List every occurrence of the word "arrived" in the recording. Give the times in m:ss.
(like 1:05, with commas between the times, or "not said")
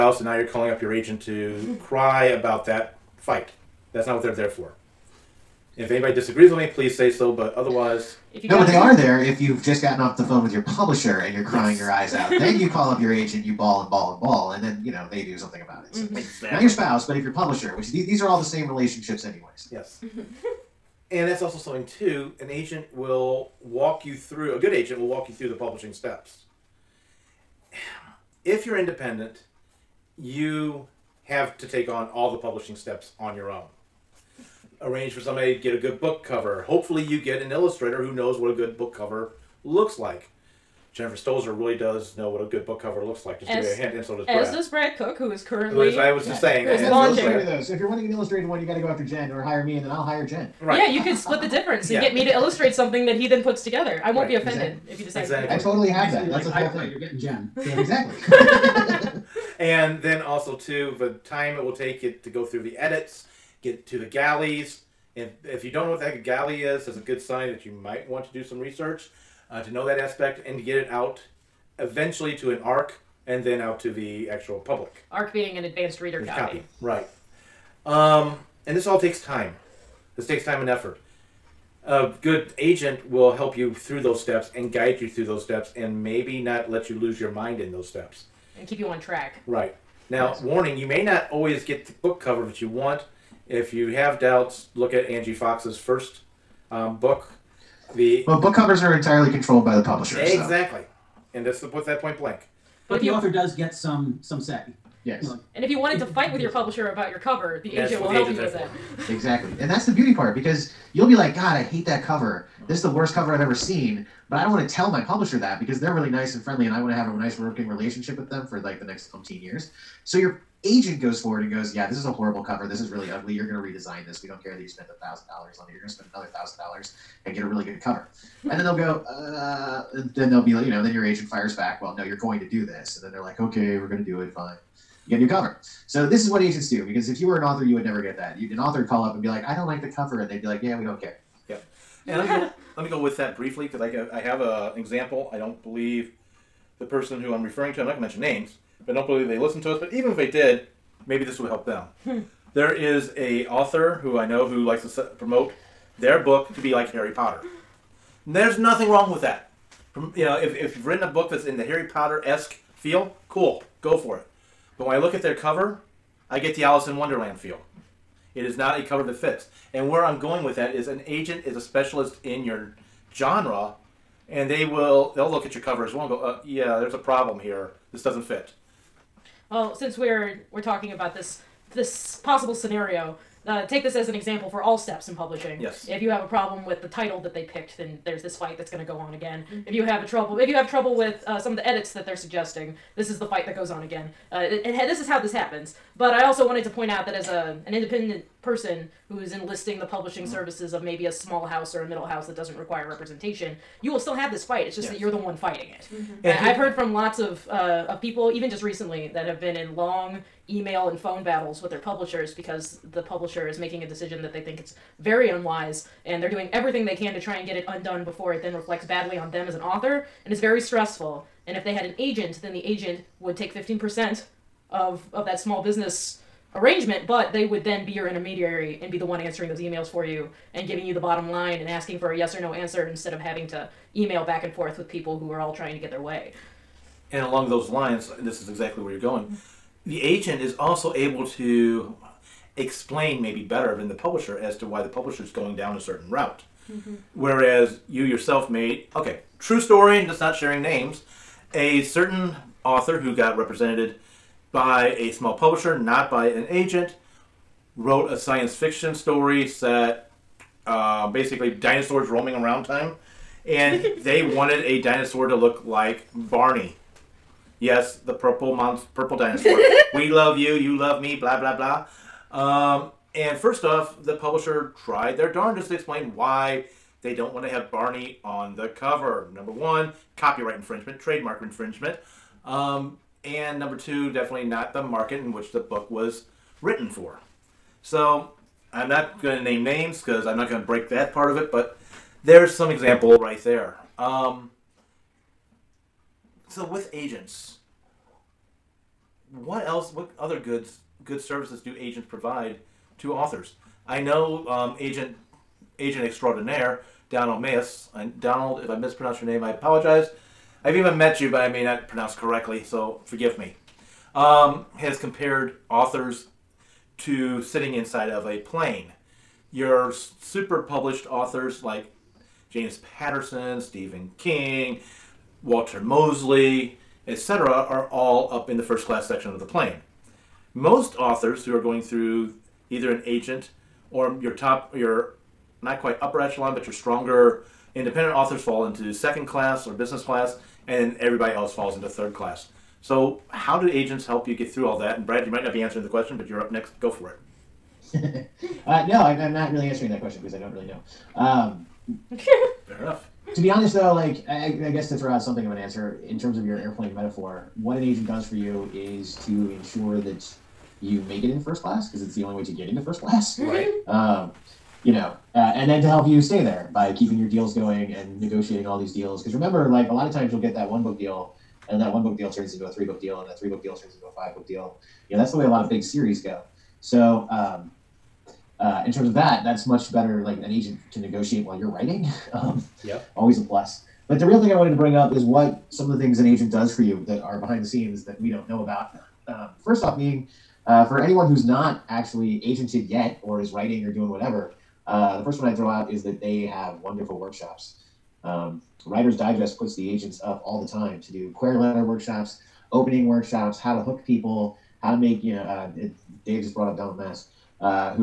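not said.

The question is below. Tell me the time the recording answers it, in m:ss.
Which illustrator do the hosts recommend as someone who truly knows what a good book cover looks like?
0:40.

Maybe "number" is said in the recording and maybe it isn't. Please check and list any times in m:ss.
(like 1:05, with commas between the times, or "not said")
4:39, 4:43.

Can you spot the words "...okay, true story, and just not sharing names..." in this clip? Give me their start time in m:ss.
4:08.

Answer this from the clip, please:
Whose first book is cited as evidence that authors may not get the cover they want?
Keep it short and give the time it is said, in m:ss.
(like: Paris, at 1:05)
Angie Fox, at 1:35.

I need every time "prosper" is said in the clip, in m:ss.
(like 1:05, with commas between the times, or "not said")
not said.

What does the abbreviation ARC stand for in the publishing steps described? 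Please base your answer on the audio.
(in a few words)
Advanced reader copy.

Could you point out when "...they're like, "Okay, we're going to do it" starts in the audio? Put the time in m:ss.
2:13.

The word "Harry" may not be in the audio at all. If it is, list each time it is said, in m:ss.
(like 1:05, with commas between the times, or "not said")
2:36, 2:41.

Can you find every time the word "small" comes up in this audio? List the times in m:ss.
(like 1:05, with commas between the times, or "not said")
3:21, 3:45, 4:15.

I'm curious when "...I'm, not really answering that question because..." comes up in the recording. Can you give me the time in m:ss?
5:49.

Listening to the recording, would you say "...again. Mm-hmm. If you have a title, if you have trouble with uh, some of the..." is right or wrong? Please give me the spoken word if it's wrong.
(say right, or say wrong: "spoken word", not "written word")
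wrong: "trouble", not "title".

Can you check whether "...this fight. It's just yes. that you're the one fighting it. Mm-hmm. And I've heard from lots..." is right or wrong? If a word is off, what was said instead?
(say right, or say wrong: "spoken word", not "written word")
right.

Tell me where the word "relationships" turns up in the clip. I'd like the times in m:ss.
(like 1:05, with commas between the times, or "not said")
0:18, 1:57.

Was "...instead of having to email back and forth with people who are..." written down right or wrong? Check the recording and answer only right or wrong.
right.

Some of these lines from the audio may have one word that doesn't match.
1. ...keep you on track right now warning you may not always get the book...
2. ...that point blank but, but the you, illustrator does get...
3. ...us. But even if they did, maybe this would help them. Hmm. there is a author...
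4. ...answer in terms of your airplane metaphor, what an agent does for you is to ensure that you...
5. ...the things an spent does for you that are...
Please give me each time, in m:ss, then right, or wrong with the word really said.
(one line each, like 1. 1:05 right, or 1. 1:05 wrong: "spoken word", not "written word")
1. 1:28 right
2. 1:41 wrong: "author", not "illustrator"
3. 2:29 right
4. 5:55 right
5. 6:25 wrong: "agent", not "spent".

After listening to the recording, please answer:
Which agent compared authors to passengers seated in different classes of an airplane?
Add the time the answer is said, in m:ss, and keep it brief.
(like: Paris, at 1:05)
Donald Maass, at 5:07.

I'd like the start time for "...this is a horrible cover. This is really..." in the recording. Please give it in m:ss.
2:01.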